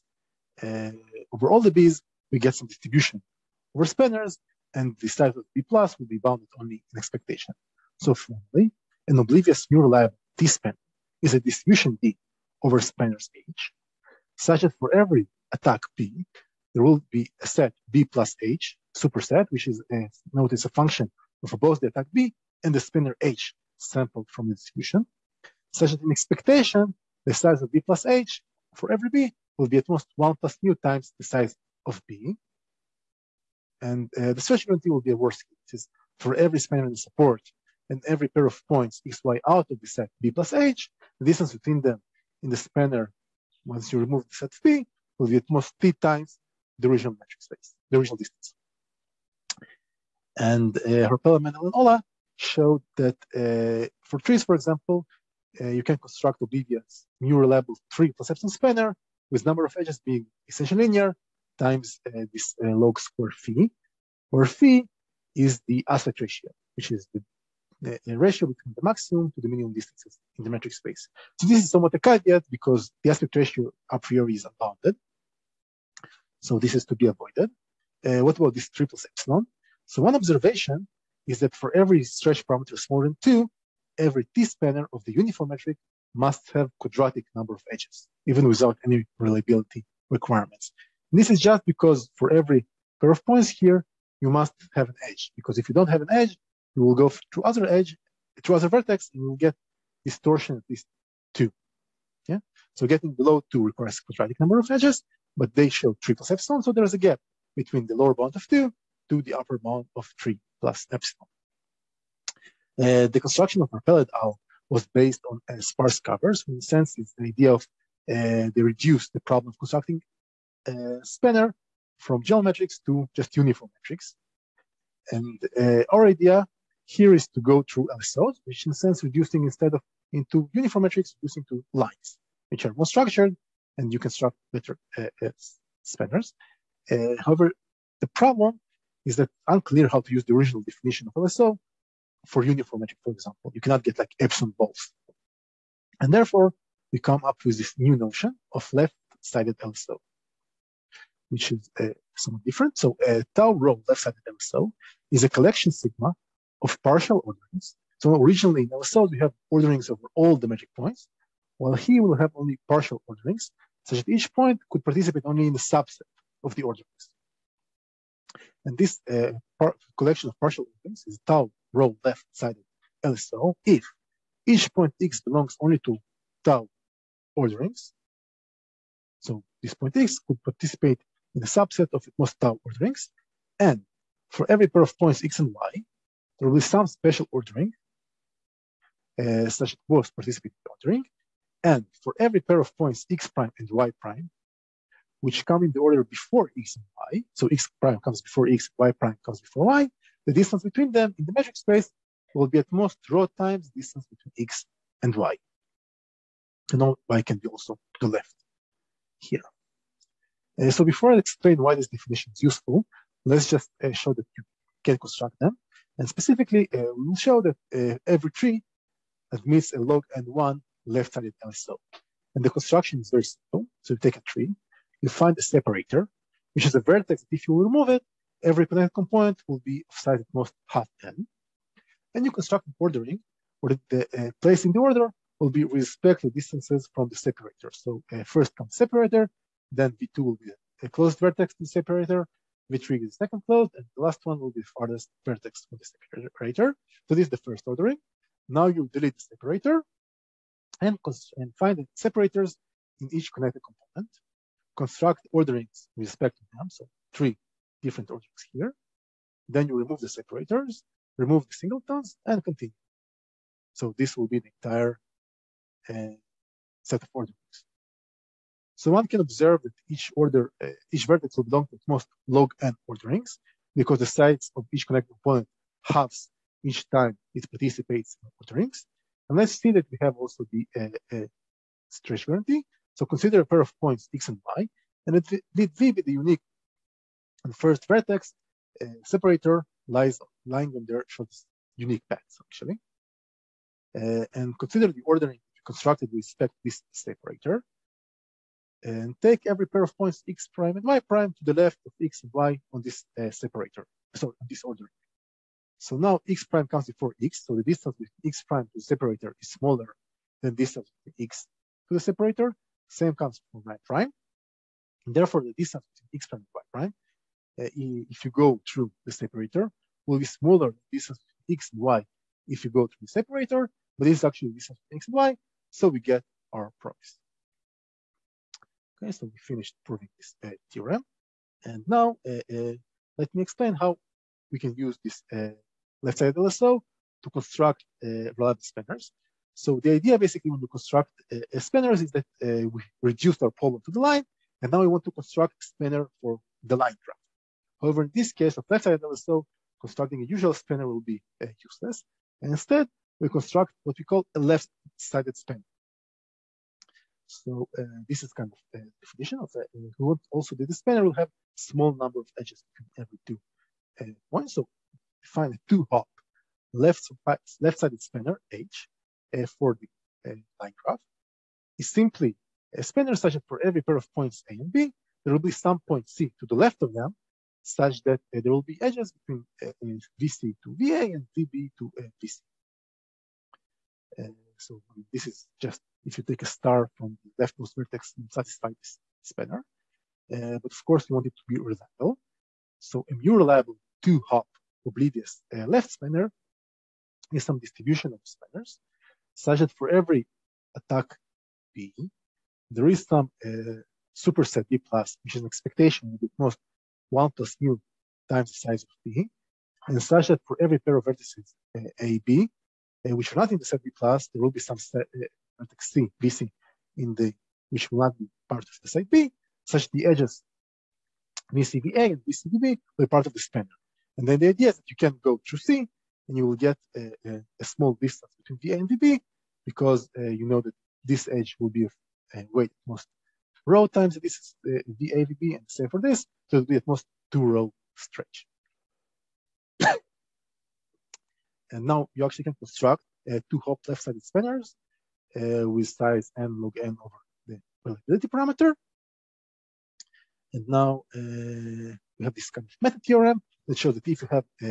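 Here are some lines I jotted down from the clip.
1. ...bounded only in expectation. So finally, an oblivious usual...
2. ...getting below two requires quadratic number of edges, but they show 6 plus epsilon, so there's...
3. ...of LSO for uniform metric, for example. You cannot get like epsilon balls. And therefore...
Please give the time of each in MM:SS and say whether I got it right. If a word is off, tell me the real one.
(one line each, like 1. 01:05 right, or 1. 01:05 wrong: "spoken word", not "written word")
1. 00:06 wrong: "neural", not "usual"
2. 01:42 wrong: "3", not "6"
3. 02:21 right.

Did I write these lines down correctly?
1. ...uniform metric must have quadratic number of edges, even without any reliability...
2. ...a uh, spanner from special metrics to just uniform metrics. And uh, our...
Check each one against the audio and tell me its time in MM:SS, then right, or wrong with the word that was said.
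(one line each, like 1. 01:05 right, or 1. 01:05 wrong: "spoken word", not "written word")
1. 01:25 right
2. 02:00 wrong: "general", not "special".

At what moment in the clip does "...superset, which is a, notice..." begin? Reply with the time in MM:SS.
00:19.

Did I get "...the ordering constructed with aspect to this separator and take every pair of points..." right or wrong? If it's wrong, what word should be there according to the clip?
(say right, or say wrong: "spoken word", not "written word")
wrong: "respect", not "aspect".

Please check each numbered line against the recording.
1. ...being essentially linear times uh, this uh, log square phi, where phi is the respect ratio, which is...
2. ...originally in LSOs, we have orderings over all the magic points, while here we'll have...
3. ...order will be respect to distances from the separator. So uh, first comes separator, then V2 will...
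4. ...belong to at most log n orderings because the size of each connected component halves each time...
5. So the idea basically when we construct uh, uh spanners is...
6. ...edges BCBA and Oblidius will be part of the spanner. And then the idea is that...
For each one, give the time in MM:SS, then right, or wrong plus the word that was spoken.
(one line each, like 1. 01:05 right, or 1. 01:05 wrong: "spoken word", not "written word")
1. 01:00 wrong: "aspect", not "respect"
2. 02:38 right
3. 03:54 right
4. 04:31 right
5. 05:39 right
6. 07:00 wrong: "BCBB", not "Oblidius".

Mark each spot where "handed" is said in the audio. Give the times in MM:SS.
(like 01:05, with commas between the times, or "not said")
03:40.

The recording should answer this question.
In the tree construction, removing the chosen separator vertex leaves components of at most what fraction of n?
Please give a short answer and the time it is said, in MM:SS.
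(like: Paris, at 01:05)
Half, at 03:50.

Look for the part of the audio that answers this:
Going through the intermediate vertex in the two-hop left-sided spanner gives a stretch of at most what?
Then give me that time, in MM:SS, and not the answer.
07:17.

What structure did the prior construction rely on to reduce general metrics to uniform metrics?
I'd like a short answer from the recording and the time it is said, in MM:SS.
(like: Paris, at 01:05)
Sparse covers, at 01:55.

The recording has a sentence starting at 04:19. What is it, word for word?
Then you remove the separators, remove the singletons, and continue.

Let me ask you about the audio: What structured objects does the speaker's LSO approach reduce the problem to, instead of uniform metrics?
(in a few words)
Lines.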